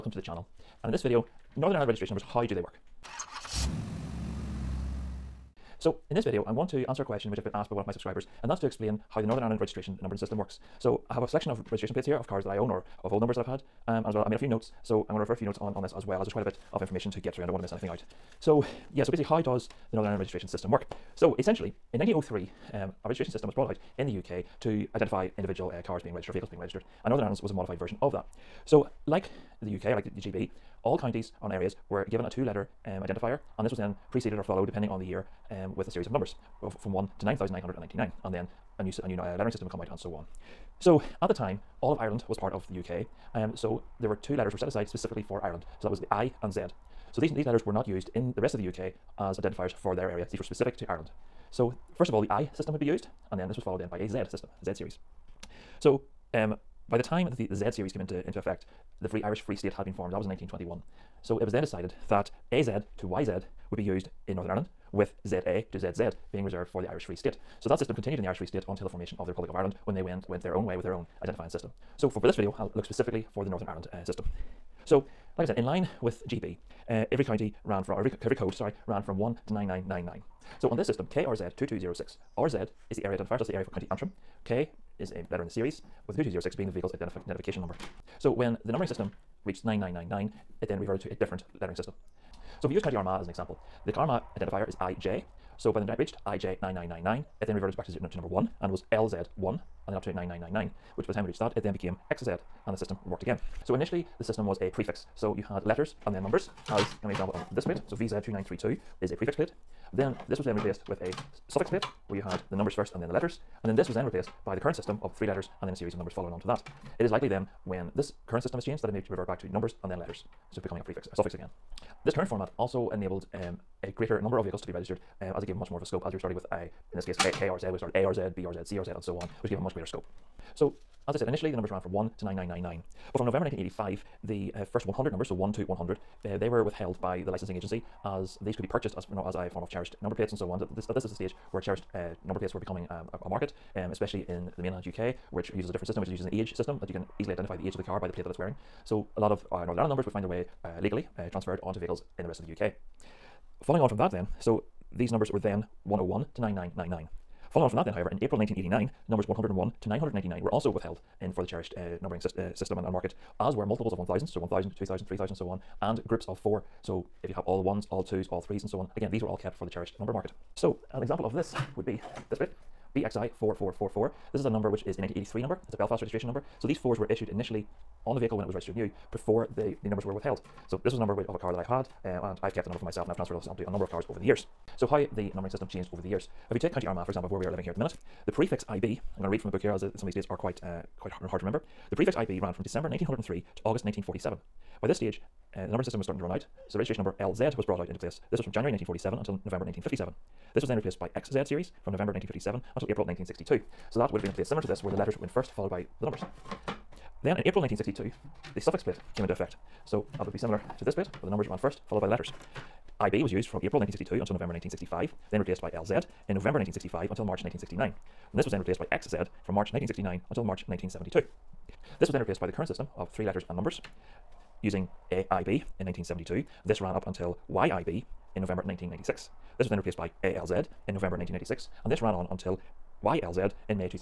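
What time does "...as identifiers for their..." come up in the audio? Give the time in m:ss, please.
0:49.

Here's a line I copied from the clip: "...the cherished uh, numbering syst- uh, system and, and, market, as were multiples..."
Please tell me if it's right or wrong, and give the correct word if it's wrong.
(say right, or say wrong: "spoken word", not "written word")
right.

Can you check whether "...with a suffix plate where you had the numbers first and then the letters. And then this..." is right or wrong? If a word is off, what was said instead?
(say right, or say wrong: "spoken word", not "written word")
right.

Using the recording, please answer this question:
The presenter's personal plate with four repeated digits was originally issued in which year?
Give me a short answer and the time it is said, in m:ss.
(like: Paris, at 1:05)
1983, at 2:55.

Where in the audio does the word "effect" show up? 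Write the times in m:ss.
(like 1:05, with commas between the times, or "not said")
0:58, 3:29.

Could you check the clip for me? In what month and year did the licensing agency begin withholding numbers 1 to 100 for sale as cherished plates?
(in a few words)
November 1985.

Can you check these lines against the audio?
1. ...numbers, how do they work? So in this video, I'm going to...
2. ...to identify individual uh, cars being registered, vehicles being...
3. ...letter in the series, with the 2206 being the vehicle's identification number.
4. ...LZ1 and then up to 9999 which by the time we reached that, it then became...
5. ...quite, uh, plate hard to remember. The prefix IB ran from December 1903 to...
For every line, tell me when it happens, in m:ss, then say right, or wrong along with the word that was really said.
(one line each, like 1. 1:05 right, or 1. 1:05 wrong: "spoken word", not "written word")
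1. 0:02 right
2. 0:24 right
3. 1:25 right
4. 1:38 right
5. 3:10 wrong: "quite", not "plate".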